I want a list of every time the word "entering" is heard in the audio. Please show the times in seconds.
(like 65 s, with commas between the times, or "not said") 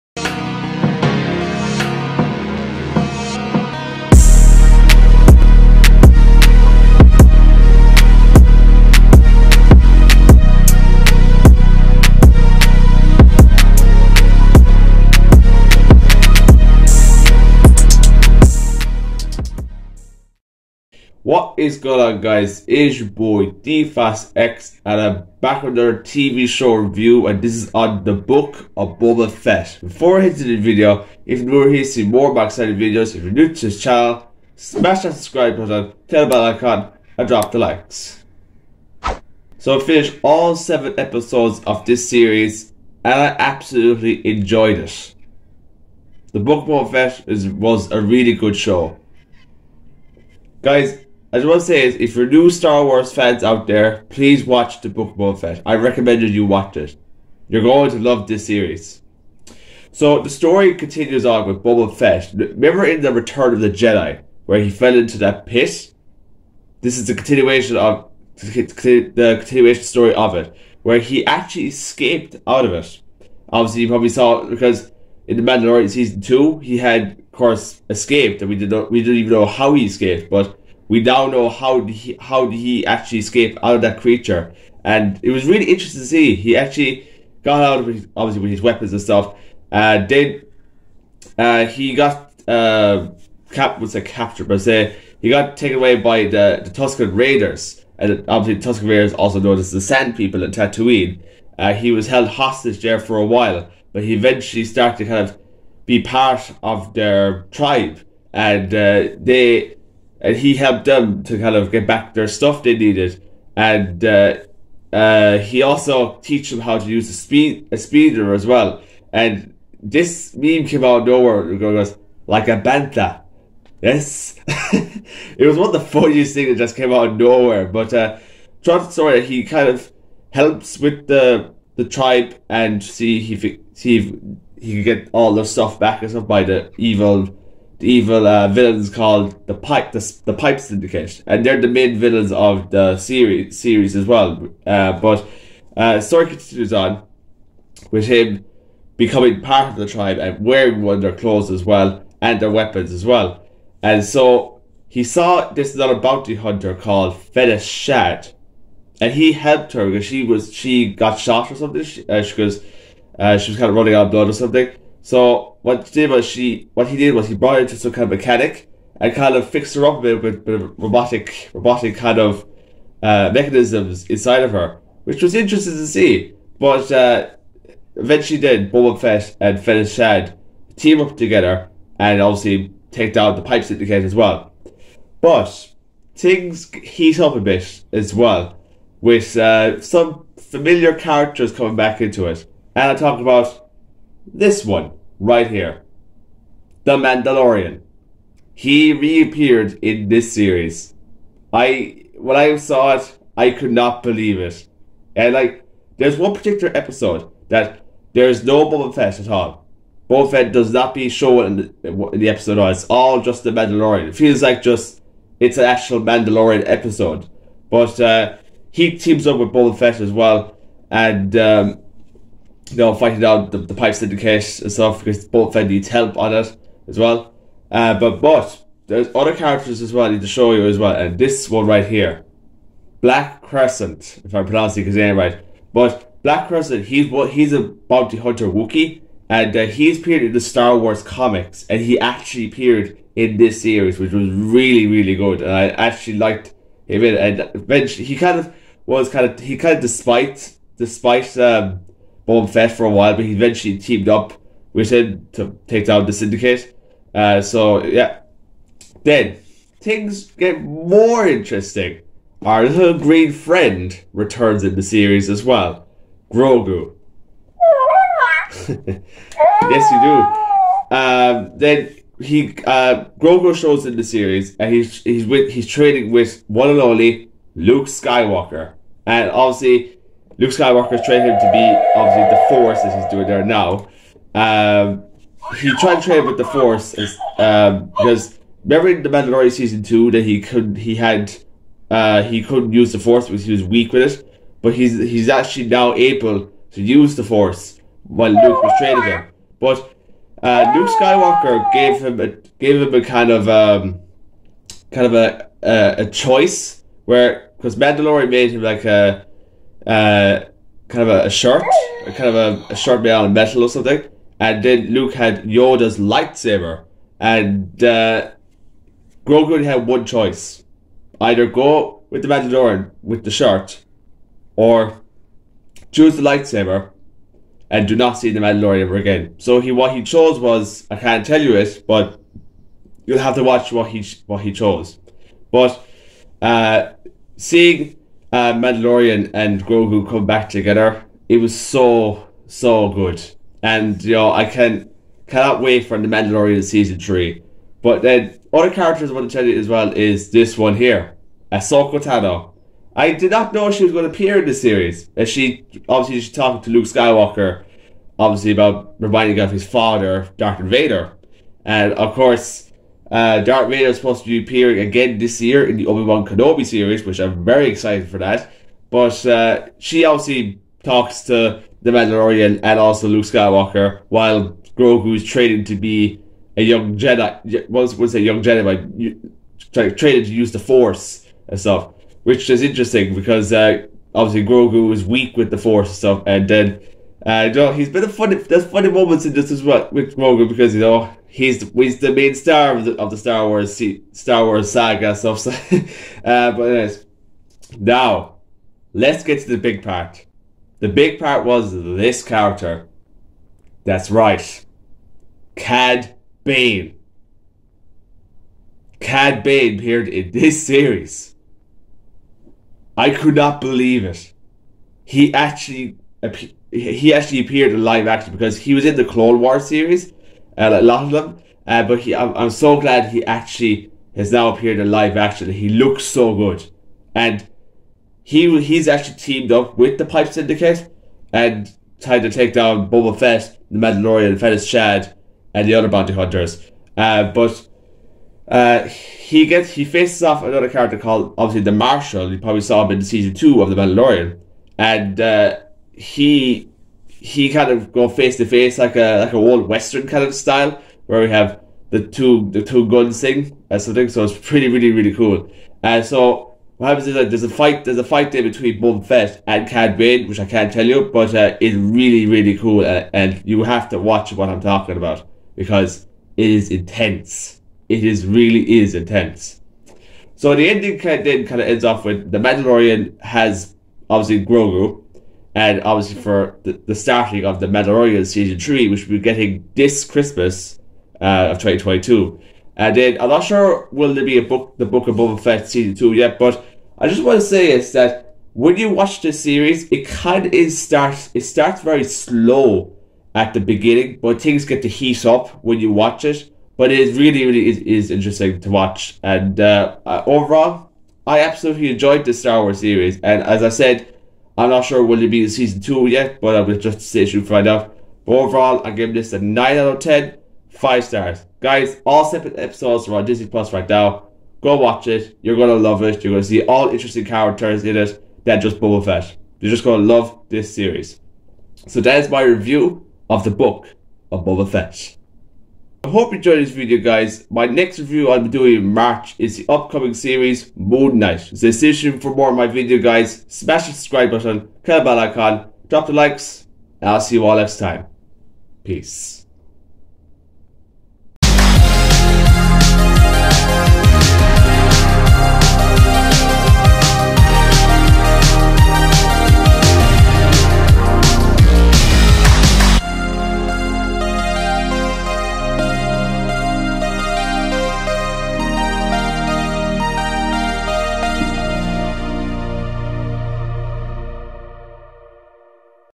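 not said.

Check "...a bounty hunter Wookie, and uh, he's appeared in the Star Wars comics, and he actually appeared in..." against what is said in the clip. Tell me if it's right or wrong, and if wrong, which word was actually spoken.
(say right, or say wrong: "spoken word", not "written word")
right.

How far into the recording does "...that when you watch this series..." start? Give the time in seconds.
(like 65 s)
487 s.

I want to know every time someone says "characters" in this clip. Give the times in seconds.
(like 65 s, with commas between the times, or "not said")
190 s, 229 s, 348 s, 402 s, 440 s, 517 s.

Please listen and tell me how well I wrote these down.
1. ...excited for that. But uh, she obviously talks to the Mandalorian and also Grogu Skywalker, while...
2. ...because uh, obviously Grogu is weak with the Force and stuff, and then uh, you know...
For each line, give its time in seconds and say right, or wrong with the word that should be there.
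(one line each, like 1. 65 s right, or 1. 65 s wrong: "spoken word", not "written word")
1. 367 s wrong: "Luke", not "Grogu"
2. 383 s right.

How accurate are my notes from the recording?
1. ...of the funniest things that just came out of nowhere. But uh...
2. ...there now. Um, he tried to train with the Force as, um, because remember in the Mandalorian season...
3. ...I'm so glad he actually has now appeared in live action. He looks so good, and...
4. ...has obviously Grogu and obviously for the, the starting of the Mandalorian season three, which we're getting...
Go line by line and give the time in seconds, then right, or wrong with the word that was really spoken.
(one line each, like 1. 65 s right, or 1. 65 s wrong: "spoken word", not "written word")
1. 125 s right
2. 283 s right
3. 422 s right
4. 473 s right.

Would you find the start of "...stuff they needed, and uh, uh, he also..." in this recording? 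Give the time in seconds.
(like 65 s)
112 s.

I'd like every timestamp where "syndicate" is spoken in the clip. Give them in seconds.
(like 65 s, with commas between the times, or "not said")
140 s, 183 s, 223 s, 256 s, 430 s.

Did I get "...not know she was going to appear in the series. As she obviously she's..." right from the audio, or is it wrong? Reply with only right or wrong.
right.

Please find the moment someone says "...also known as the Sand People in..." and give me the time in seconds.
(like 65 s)
99 s.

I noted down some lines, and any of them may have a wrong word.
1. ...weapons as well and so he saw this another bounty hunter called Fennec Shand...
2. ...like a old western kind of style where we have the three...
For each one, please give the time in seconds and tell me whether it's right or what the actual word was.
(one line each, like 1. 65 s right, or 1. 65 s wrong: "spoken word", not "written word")
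1. 152 s right
2. 449 s wrong: "two", not "three".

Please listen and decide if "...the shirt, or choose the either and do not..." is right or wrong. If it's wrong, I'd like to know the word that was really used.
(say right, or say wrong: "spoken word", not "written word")
wrong: "lightsaber", not "either".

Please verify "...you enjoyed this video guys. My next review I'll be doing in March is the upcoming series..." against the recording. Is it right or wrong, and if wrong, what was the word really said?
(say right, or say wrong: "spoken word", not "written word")
right.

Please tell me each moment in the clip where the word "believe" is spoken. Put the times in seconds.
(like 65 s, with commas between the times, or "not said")
204 s, 413 s.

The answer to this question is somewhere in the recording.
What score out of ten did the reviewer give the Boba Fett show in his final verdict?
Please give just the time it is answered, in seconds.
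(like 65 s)
509 s.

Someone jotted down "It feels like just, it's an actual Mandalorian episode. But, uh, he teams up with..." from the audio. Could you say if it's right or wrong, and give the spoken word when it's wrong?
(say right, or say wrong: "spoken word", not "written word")
right.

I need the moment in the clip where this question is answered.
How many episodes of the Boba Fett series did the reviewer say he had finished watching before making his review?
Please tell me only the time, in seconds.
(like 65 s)
40 s.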